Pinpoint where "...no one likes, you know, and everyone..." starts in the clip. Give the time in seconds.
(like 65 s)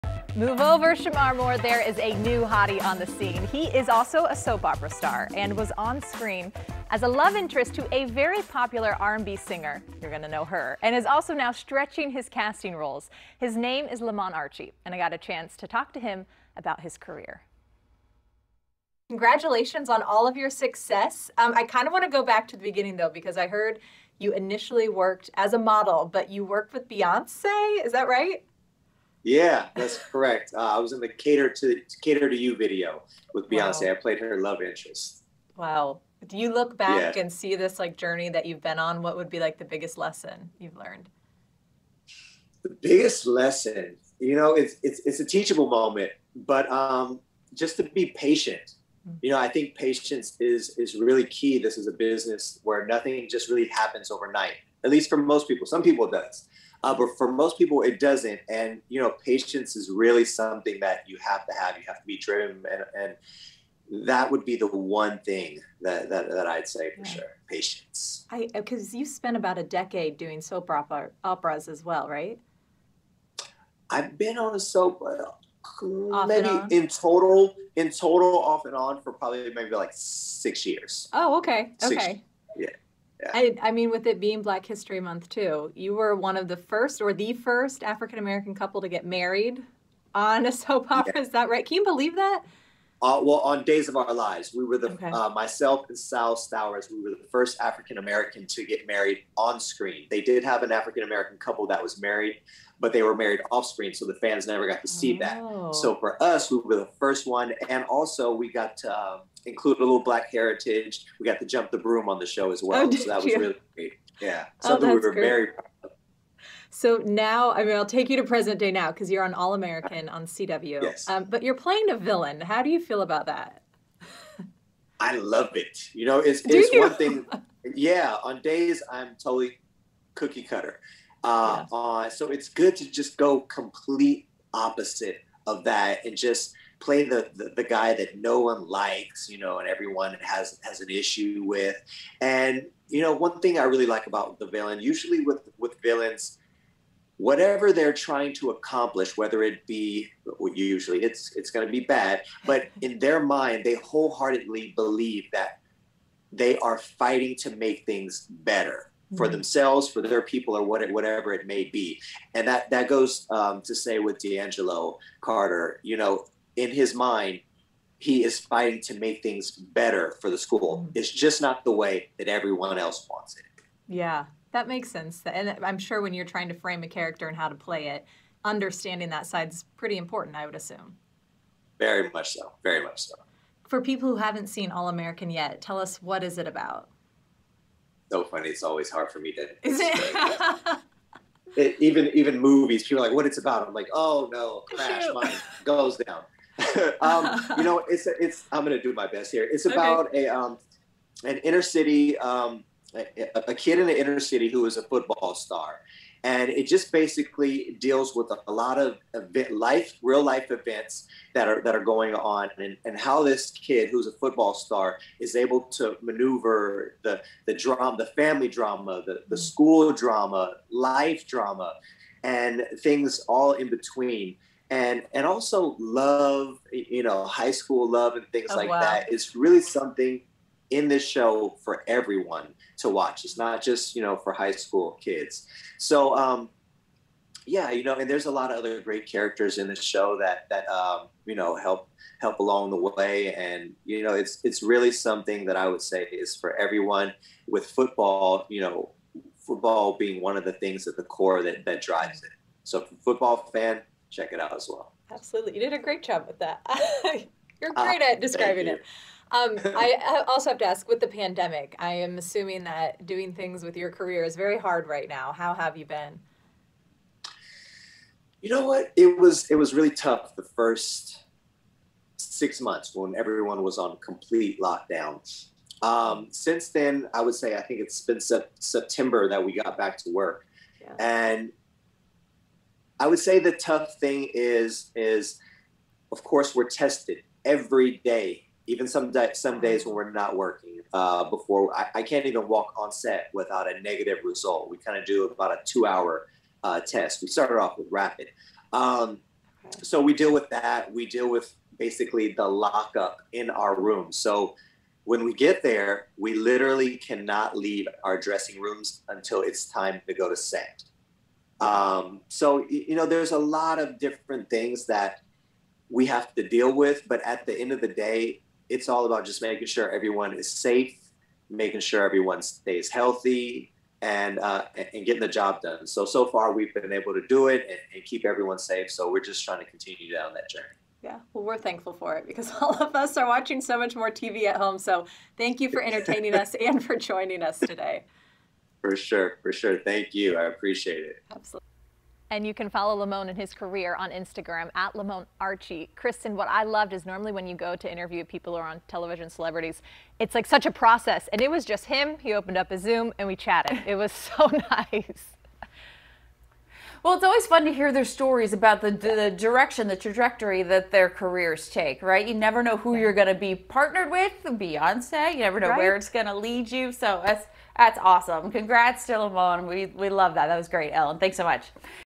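138 s.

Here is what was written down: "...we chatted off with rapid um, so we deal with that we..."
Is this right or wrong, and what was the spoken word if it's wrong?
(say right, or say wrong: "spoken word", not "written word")
wrong: "started", not "chatted".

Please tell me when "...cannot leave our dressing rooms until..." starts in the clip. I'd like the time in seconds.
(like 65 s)
306 s.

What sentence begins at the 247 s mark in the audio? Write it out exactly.
With football, you know, football being one of the things at the core that that drives it.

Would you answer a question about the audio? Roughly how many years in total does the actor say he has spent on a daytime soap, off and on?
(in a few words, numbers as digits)
6.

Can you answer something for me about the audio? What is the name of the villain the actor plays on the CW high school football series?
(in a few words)
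D'Angelo Carter.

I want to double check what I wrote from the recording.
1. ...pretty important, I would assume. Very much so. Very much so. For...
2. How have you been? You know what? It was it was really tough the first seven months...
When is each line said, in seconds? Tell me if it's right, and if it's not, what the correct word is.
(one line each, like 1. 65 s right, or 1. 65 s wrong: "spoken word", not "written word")
1. 179 s right
2. 265 s wrong: "six", not "seven".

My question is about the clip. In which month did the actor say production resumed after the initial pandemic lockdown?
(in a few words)
September.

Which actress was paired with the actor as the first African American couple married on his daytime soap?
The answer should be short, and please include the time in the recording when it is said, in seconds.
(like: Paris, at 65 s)
Sal Stowers, at 95 s.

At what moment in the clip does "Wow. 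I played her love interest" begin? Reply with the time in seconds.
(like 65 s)
33 s.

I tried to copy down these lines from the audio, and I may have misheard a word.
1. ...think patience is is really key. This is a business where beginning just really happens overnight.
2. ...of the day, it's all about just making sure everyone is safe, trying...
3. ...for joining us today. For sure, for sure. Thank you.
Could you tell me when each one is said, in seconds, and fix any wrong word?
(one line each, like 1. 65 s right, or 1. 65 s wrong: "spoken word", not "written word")
1. 49 s wrong: "nothing", not "beginning"
2. 317 s wrong: "making", not "trying"
3. 336 s right.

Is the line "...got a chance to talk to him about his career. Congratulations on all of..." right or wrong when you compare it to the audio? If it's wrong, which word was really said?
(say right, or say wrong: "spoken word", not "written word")
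right.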